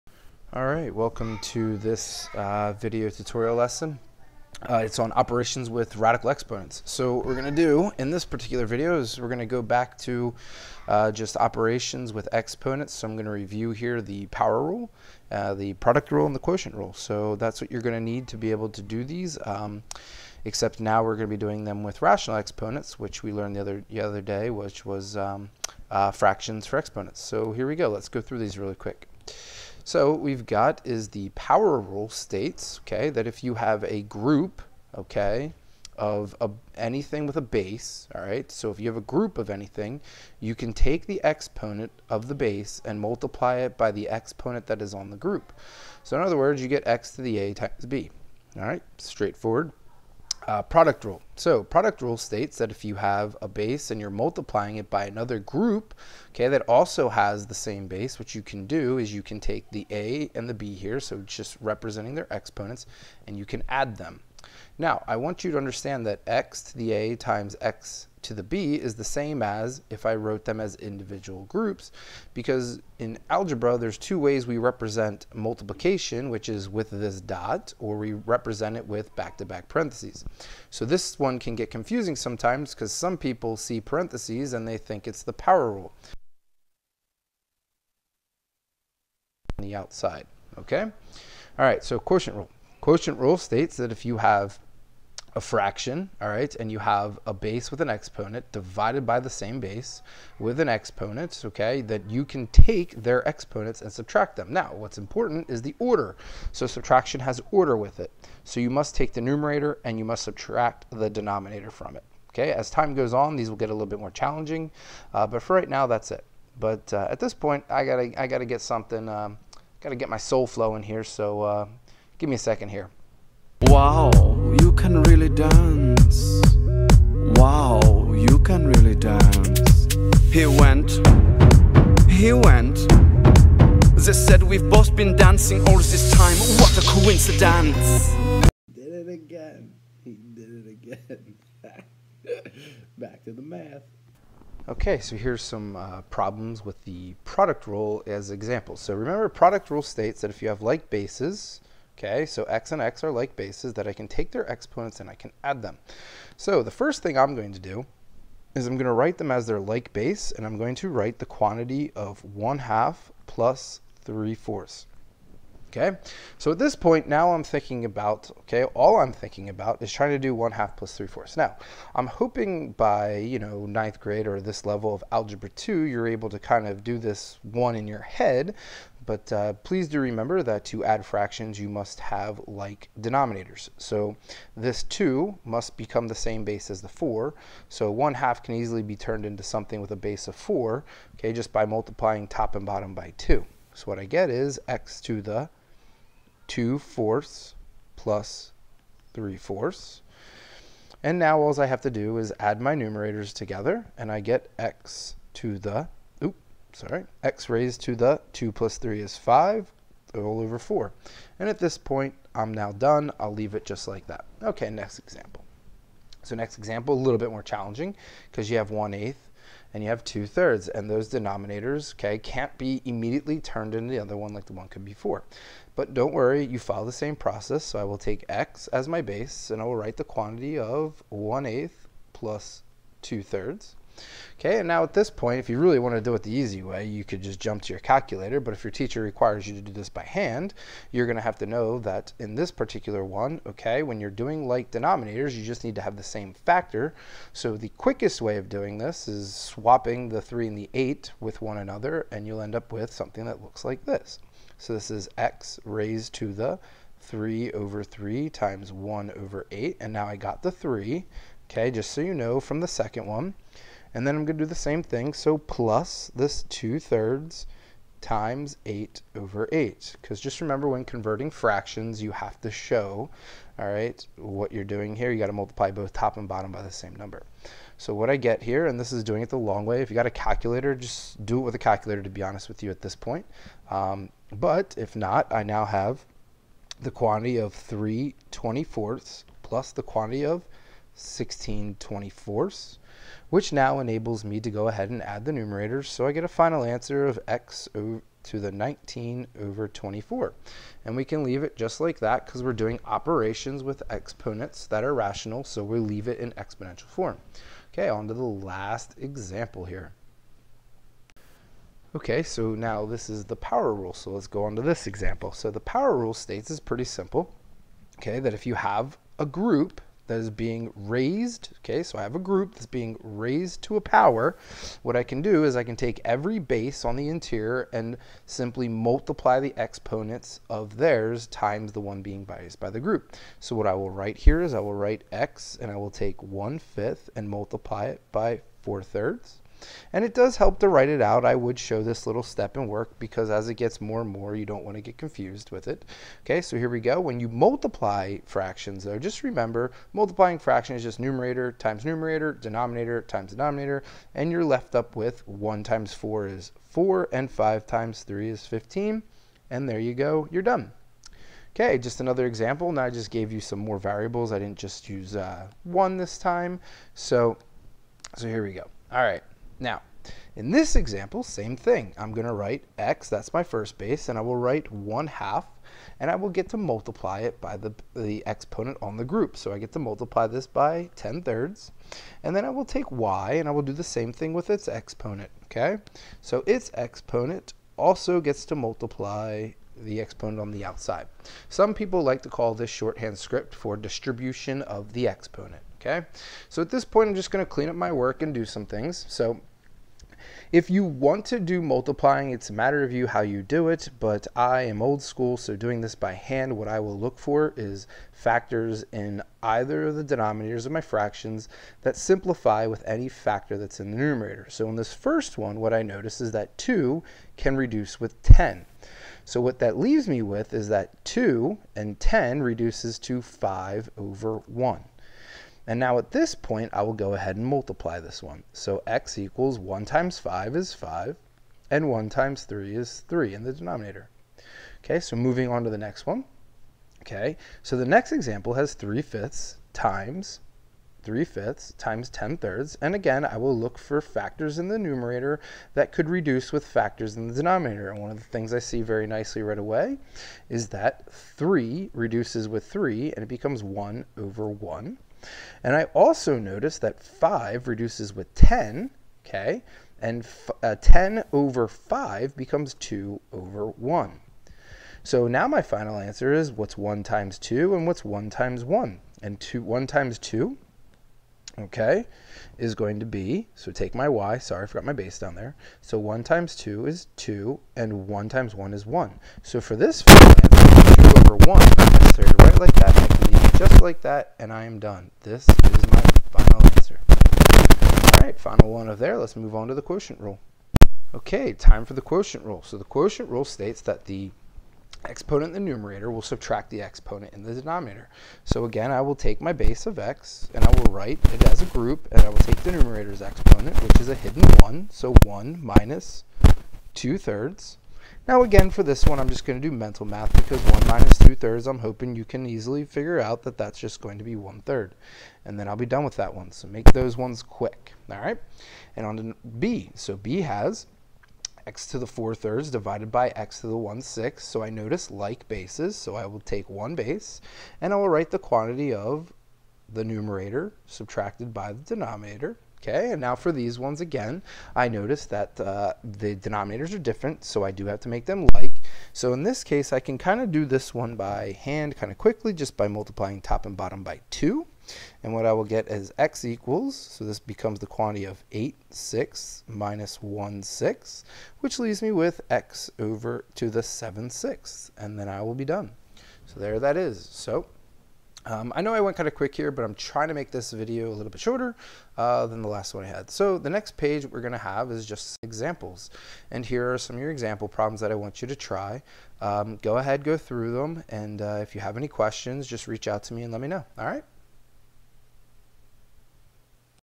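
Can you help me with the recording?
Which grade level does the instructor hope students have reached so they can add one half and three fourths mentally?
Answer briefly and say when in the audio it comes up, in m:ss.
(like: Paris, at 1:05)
ninth grade, at 2:53.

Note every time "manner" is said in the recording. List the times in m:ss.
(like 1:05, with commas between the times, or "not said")
not said.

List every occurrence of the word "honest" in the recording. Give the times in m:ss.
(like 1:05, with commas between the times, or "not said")
4:42.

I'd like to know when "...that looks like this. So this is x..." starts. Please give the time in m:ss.
4:13.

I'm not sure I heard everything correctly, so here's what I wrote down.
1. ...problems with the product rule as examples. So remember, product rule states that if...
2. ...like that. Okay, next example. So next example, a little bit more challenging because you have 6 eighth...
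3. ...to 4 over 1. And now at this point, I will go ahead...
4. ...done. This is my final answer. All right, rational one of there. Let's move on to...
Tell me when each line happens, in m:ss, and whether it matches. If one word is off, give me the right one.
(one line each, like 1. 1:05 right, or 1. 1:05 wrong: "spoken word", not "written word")
1. 2:26 right
2. 3:33 wrong: "1", not "6"
3. 7:02 wrong: "5", not "4"
4. 8:04 wrong: "final", not "rational".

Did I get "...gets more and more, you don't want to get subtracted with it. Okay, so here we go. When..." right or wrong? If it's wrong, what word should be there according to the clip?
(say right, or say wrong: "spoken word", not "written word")
wrong: "confused", not "subtracted".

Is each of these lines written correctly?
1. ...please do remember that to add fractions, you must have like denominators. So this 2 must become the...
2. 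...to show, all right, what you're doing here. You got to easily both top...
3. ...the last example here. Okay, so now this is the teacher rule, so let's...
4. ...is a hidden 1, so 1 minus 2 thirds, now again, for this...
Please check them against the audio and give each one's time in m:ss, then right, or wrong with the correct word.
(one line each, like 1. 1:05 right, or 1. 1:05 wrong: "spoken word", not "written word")
1. 2:59 right
2. 4:32 wrong: "multiply", not "easily"
3. 5:08 wrong: "power", not "teacher"
4. 8:24 right.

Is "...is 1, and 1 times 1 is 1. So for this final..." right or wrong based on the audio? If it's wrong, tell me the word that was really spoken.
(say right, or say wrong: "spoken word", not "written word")
wrong: "2", not "1".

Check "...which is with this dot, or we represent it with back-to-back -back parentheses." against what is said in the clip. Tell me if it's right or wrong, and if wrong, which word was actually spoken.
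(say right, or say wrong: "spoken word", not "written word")
right.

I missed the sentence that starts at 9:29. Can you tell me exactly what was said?
Um, go ahead, go through them, and uh, if you have any questions, just reach out to me and let me know.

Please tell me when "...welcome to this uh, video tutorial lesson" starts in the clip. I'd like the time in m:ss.
0:00.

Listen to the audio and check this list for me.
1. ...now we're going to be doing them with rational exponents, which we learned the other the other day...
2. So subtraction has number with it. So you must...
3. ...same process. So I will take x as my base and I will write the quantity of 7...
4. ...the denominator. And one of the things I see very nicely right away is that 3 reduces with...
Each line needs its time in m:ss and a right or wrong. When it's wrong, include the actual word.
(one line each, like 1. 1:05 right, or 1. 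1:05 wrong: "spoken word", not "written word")
1. 0:20 right
2. 1:46 wrong: "order", not "number"
3. 3:46 wrong: "1", not "7"
4. 7:27 right.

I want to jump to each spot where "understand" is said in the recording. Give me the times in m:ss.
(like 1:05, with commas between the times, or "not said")
1:05.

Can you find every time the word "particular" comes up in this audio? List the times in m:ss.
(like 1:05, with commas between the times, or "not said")
0:08, 4:02.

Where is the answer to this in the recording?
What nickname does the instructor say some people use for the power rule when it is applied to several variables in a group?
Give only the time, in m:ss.
6:32.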